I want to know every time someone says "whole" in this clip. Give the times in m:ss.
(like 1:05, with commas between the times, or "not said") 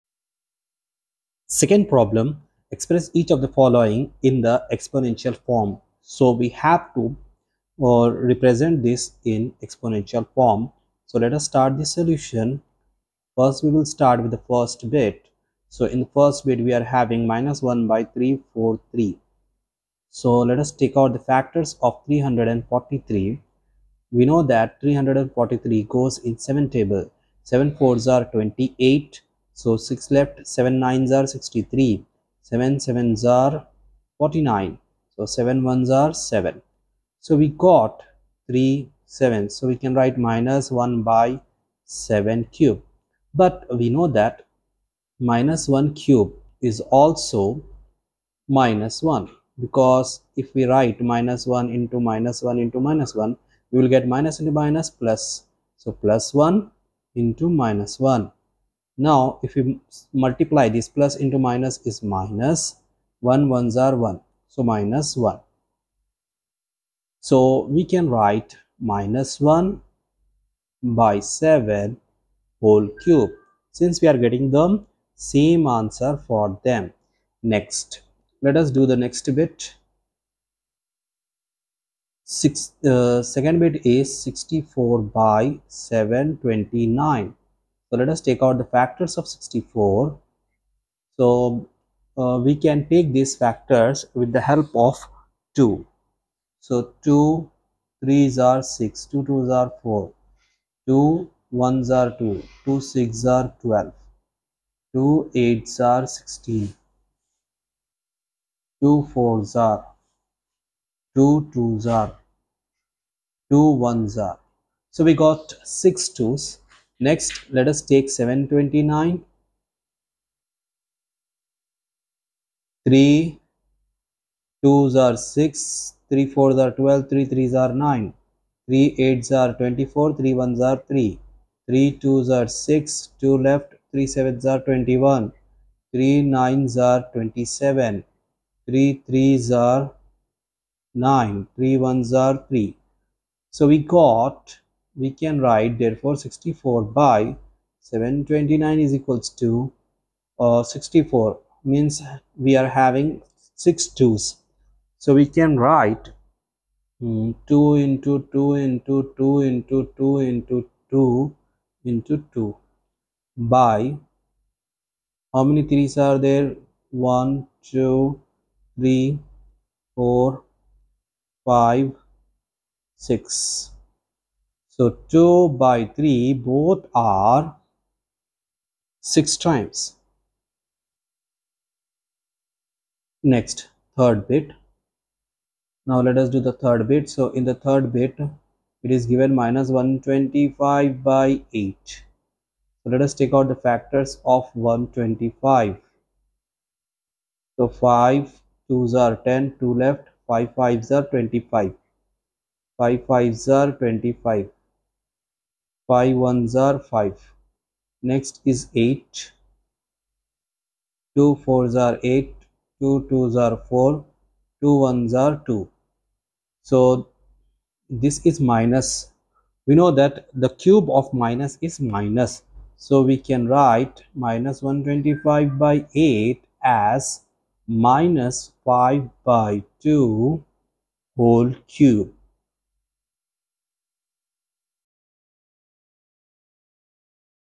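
1:12, 3:51.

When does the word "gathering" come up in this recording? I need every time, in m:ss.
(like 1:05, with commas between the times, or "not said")
not said.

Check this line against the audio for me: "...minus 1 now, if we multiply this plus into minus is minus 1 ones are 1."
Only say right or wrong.
right.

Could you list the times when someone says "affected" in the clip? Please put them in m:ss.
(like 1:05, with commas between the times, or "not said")
not said.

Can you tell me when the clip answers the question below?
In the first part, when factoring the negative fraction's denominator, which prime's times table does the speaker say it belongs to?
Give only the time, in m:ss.
0:26.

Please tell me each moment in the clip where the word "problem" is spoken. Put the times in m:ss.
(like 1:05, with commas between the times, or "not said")
0:01.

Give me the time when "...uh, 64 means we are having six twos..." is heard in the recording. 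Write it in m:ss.
2:30.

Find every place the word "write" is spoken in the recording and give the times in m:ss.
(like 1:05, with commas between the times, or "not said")
0:39, 0:50, 1:08, 2:25, 2:35, 3:43.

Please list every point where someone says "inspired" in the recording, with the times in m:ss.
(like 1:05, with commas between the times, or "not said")
not said.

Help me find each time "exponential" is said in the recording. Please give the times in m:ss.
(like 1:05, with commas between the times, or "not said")
0:04, 0:09.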